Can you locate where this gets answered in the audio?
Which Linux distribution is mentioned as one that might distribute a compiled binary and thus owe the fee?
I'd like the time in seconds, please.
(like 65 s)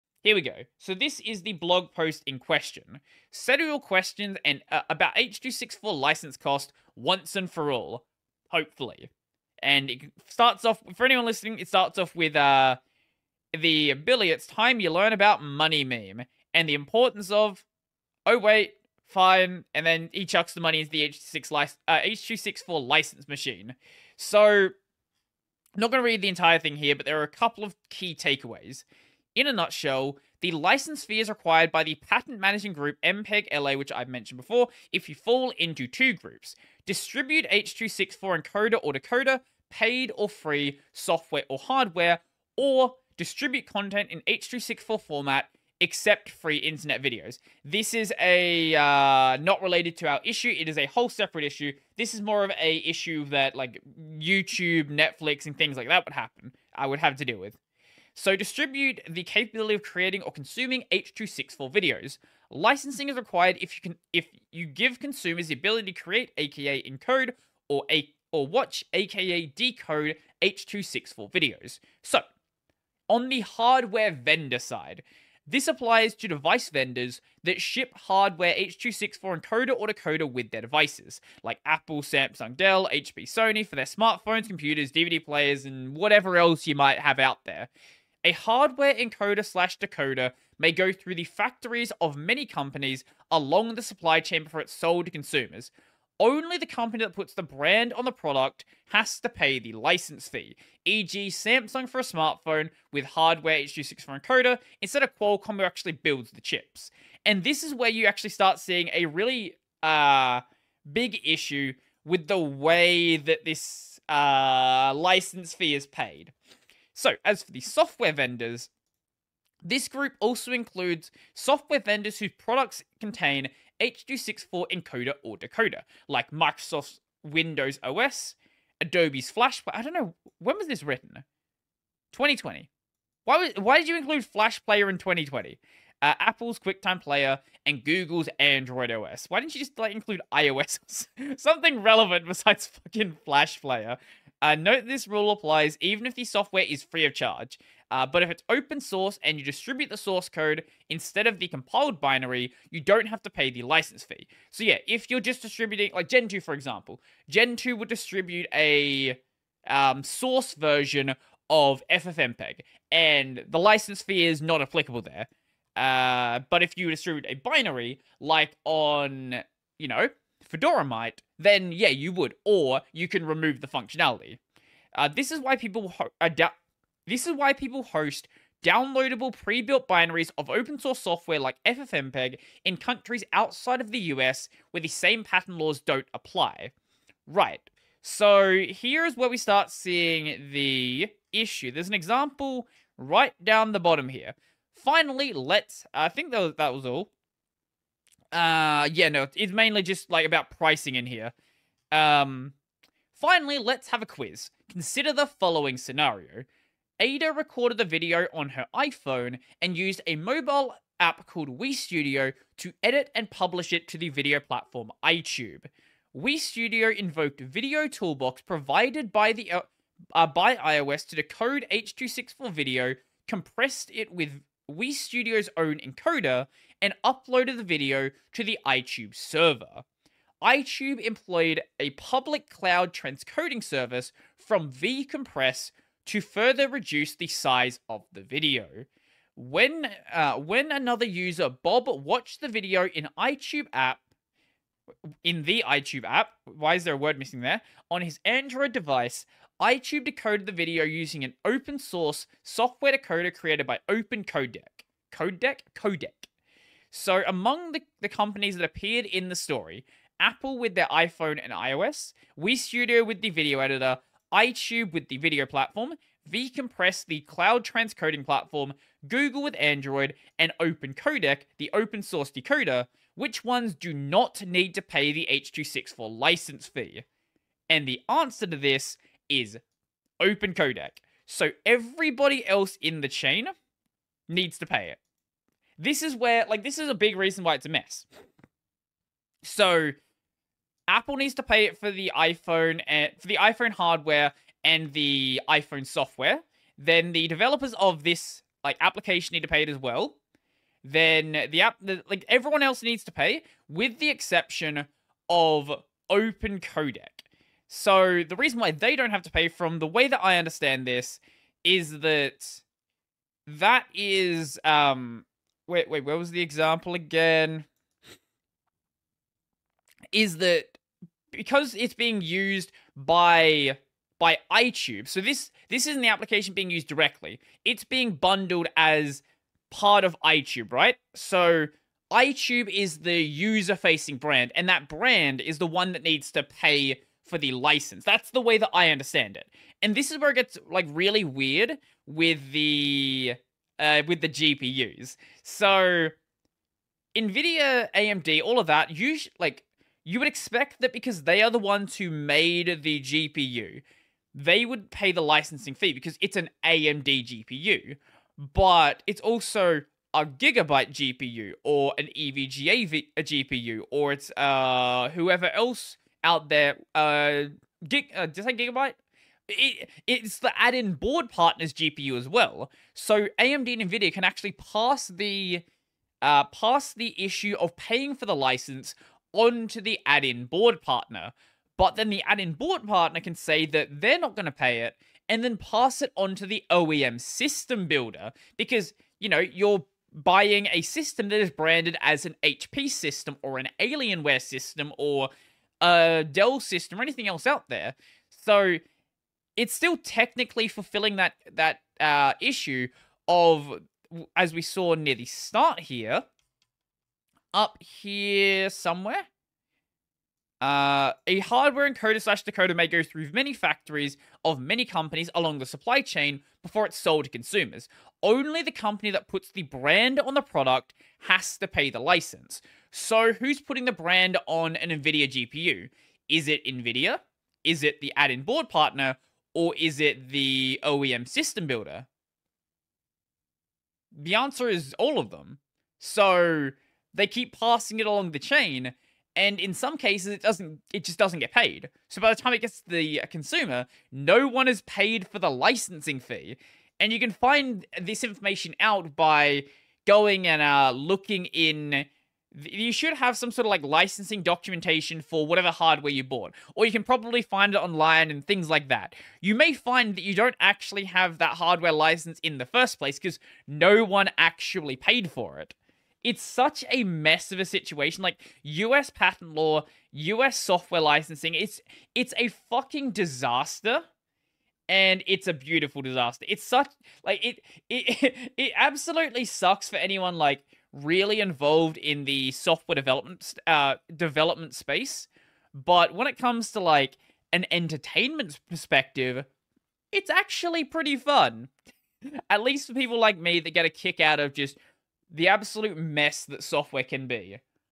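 170 s.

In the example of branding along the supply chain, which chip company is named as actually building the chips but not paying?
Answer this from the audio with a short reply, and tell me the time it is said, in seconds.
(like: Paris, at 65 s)
Qualcomm, at 105 s.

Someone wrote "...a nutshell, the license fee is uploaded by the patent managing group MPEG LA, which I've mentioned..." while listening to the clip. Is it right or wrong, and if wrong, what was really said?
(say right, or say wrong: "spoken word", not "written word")
wrong: "required", not "uploaded".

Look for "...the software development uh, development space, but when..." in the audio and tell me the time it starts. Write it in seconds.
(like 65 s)
482 s.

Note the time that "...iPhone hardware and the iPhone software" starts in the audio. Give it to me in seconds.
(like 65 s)
293 s.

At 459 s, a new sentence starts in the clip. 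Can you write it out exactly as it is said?
You may find that you don't actually have that hardware license in the first place because no one actually paid for it.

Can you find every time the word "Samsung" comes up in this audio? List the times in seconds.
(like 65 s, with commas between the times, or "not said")
82 s, 101 s.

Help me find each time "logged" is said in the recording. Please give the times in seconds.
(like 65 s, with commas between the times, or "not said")
not said.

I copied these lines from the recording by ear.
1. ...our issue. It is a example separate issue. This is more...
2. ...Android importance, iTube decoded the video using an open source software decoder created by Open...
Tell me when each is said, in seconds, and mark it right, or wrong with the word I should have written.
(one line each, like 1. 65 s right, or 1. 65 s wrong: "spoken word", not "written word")
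1. 50 s wrong: "whole", not "example"
2. 248 s wrong: "device", not "importance".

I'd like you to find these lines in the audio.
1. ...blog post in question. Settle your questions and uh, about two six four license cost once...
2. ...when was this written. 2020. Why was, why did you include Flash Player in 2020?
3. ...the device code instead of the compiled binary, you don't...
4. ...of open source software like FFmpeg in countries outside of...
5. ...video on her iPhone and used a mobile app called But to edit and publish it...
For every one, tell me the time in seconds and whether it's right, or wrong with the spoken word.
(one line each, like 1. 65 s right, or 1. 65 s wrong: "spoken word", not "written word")
1. 1 s right
2. 130 s right
3. 149 s wrong: "source", not "device"
4. 180 s right
5. 207 s wrong: "Studio", not "But".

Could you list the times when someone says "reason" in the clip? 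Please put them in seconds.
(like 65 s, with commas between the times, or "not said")
287 s, 308 s.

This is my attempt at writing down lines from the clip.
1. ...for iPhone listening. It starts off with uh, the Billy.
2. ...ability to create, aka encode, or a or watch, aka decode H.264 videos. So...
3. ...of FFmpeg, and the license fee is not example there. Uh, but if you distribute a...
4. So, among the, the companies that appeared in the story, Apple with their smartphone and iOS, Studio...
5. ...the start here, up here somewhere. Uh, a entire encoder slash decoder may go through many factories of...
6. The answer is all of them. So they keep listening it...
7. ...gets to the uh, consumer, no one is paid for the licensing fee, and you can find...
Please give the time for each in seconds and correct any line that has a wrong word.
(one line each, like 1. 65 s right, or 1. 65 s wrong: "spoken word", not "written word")
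1. 10 s wrong: "anyone", not "iPhone"
2. 65 s right
3. 161 s wrong: "applicable", not "example"
4. 256 s wrong: "iPhone", not "smartphone"
5. 405 s wrong: "hardware", not "entire"
6. 434 s wrong: "passing", not "listening"
7. 442 s right.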